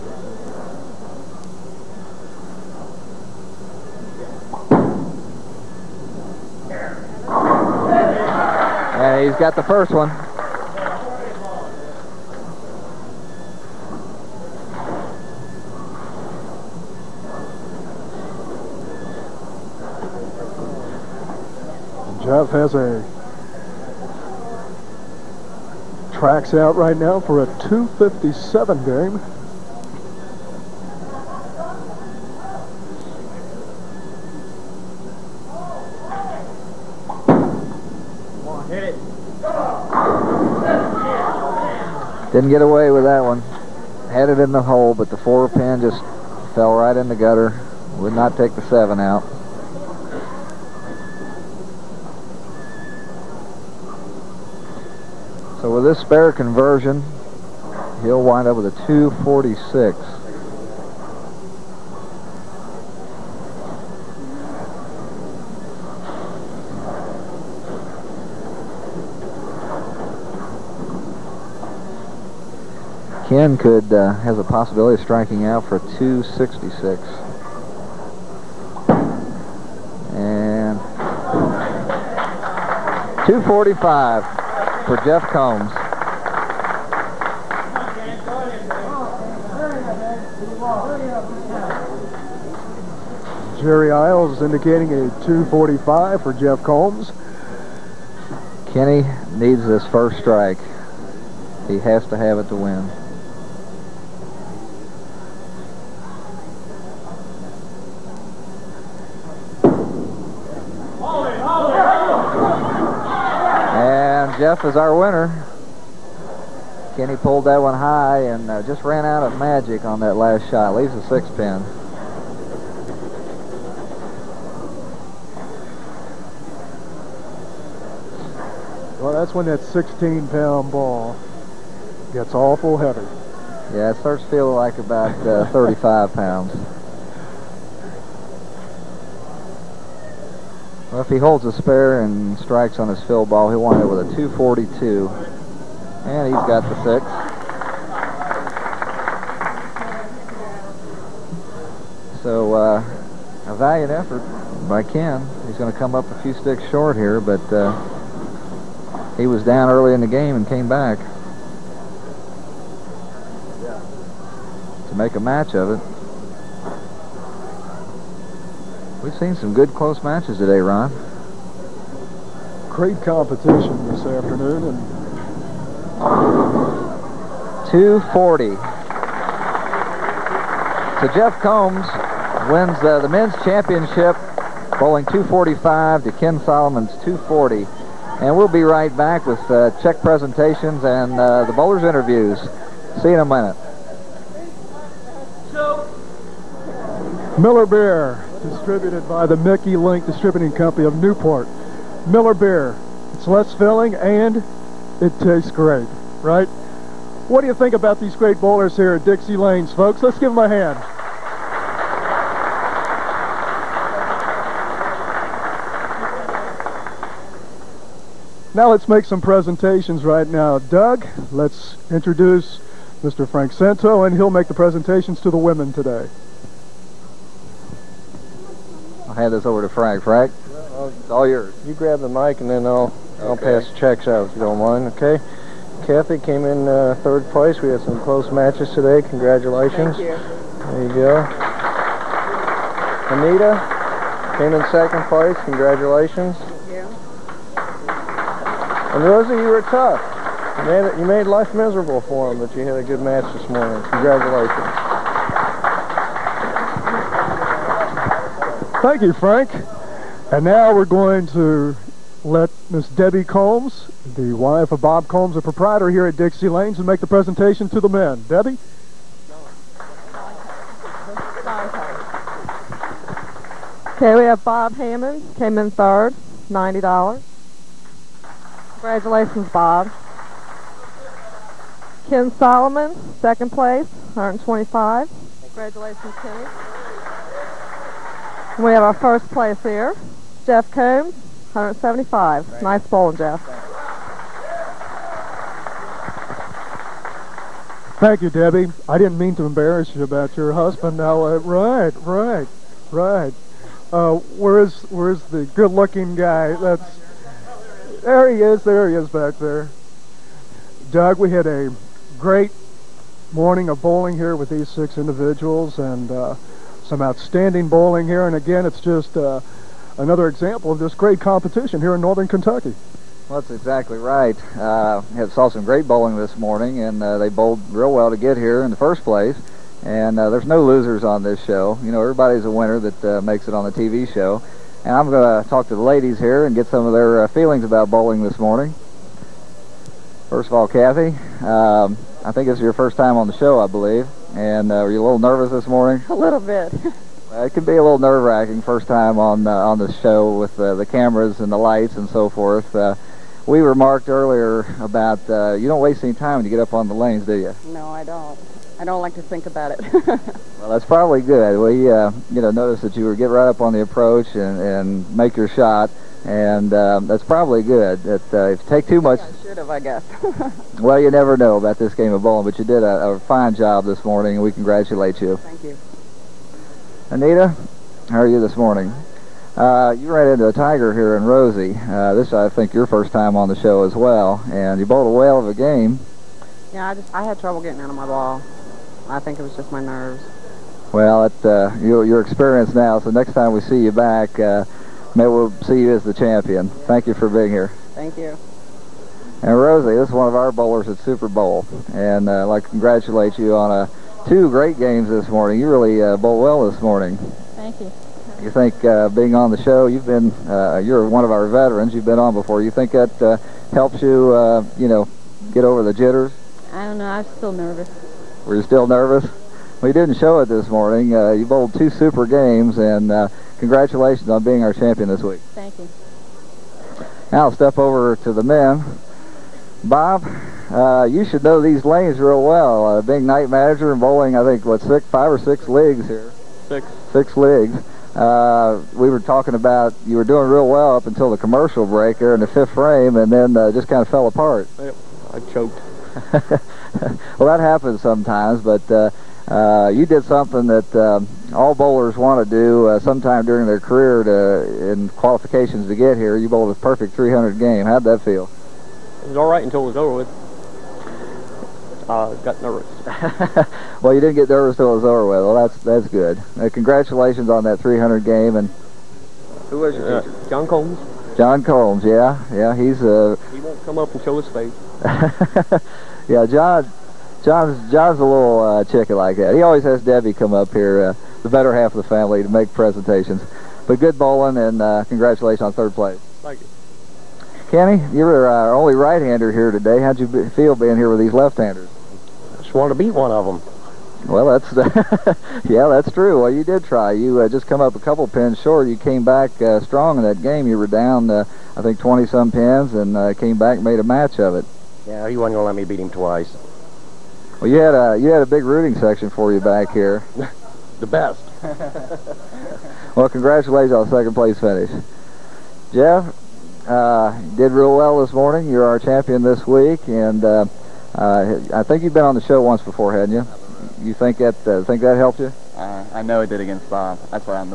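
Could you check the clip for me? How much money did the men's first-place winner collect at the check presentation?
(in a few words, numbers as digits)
175.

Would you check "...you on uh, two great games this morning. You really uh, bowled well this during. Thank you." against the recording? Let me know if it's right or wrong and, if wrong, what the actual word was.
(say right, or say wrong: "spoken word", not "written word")
wrong: "morning", not "during".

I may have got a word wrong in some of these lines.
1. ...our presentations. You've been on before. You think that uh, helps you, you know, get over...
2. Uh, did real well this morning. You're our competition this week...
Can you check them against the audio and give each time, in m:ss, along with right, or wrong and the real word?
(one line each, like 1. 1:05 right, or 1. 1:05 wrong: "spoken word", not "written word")
1. 6:51 wrong: "veterans", not "presentations"
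2. 8:36 wrong: "champion", not "competition".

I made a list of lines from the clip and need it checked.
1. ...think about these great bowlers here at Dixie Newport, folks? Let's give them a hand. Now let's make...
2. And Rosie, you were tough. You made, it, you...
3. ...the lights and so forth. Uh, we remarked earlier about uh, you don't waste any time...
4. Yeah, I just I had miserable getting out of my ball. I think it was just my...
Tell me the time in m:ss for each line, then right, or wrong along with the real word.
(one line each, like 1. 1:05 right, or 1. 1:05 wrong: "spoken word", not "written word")
1. 3:27 wrong: "Lanes", not "Newport"
2. 4:08 right
3. 5:51 right
4. 6:26 wrong: "trouble", not "miserable".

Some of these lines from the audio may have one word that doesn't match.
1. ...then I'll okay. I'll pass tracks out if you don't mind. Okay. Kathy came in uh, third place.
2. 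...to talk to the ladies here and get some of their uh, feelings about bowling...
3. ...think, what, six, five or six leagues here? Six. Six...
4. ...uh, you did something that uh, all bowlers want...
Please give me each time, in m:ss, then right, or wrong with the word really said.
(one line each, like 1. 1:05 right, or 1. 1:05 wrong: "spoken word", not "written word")
1. 3:52 wrong: "checks", not "tracks"
2. 5:35 right
3. 7:14 right
4. 7:29 right.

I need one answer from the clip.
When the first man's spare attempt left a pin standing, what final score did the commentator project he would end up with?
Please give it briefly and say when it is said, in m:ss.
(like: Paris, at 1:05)
246, at 0:58.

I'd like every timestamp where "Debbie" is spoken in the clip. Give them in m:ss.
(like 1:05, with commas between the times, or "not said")
4:22, 4:28, 4:58, 8:00.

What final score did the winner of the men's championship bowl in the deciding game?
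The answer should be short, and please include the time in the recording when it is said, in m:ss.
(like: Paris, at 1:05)
245, at 3:05.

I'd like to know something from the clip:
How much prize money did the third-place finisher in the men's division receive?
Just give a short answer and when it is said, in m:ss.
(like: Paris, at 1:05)
$90, at 4:36.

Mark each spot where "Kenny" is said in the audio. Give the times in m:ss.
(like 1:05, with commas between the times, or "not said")
1:38, 1:56, 4:46, 8:07.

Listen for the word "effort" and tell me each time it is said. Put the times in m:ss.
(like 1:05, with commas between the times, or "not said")
2:33.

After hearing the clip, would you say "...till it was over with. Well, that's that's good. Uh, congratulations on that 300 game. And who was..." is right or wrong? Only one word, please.
right.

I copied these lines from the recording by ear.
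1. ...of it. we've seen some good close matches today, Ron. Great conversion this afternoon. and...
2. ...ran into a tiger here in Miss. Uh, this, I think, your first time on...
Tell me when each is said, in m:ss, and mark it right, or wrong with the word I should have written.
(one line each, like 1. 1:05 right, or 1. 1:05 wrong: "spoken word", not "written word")
1. 2:45 wrong: "competition", not "conversion"
2. 6:20 wrong: "Rosie", not "Miss".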